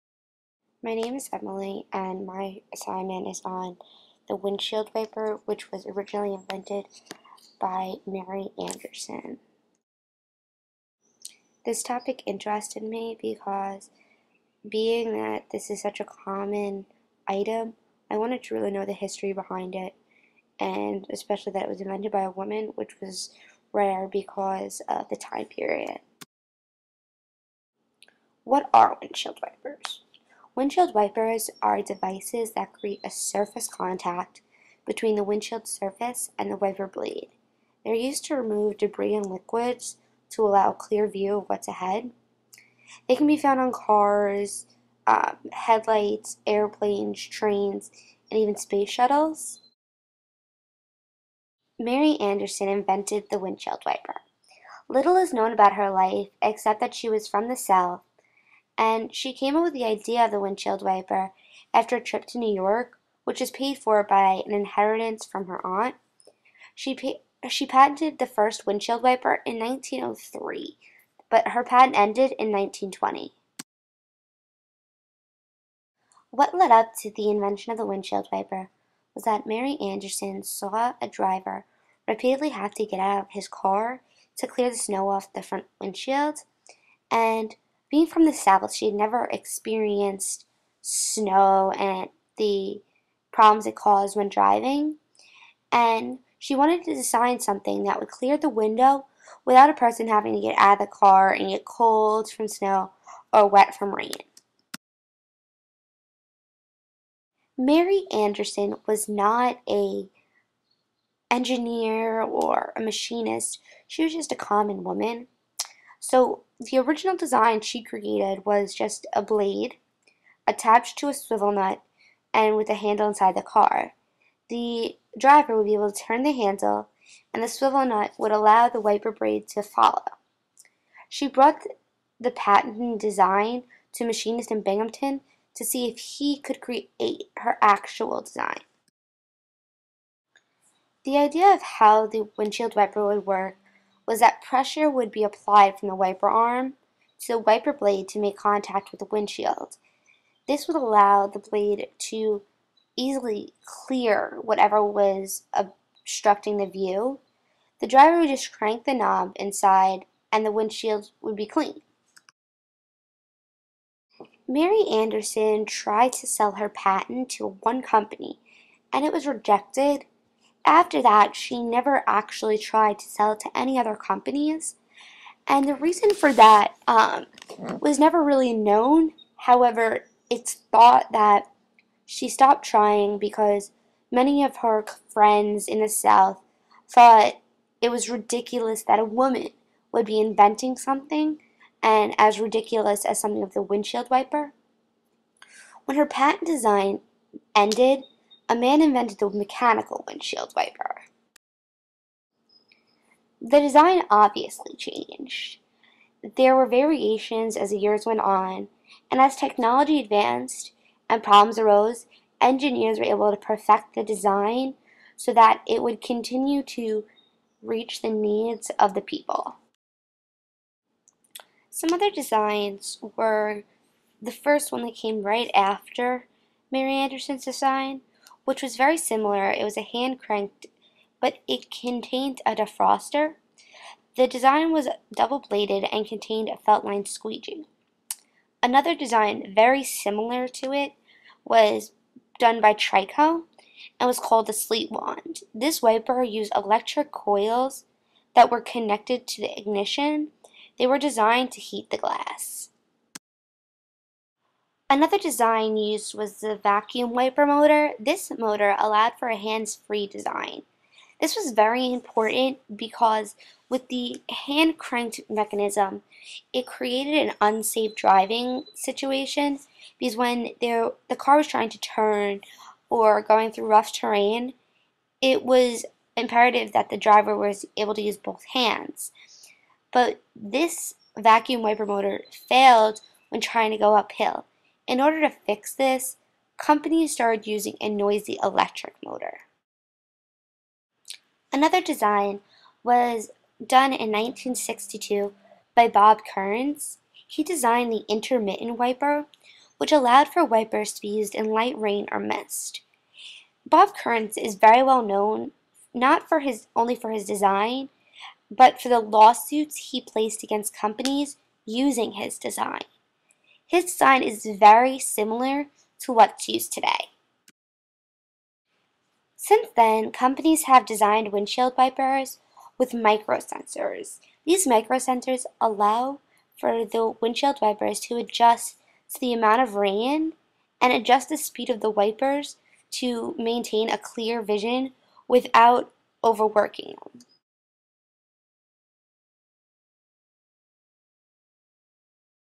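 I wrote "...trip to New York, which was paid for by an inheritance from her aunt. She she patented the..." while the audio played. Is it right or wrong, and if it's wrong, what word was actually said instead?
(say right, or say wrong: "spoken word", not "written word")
right.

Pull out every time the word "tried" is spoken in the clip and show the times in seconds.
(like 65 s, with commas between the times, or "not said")
165 s, 172 s.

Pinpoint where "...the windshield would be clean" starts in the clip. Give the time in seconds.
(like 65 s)
160 s.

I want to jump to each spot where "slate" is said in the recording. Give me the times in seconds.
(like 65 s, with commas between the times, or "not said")
not said.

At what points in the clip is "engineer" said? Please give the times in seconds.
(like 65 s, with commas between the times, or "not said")
111 s, 212 s.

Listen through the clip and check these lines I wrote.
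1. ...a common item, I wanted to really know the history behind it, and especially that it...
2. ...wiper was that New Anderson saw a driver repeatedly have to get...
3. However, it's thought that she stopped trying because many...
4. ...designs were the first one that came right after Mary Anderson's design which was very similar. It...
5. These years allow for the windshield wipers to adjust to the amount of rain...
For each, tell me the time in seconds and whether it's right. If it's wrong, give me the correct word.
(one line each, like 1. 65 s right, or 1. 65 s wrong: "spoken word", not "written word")
1. 15 s right
2. 78 s wrong: "Mary", not "New"
3. 179 s right
4. 222 s right
5. 324 s wrong: "microsensors", not "years".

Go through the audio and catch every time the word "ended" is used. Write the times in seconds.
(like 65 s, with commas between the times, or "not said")
71 s, 197 s.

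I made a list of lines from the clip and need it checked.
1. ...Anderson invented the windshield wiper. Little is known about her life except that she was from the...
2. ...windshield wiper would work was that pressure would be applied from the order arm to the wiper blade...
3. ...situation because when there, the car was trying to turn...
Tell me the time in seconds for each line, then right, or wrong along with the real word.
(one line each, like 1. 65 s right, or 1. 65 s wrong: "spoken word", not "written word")
1. 52 s right
2. 142 s wrong: "wiper", not "order"
3. 268 s right.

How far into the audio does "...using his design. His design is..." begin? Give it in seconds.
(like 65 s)
311 s.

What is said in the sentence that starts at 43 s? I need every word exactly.
They can be found on cars, um, headlights, airplanes, trains, and even space shuttles.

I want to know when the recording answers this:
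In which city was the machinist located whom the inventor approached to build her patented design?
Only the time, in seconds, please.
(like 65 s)
134 s.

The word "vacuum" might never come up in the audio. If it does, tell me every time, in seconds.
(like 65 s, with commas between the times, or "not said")
256 s, 281 s.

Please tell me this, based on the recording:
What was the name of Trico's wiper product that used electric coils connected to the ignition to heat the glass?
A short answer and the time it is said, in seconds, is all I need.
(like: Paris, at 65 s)
Sleet Wand, at 244 s.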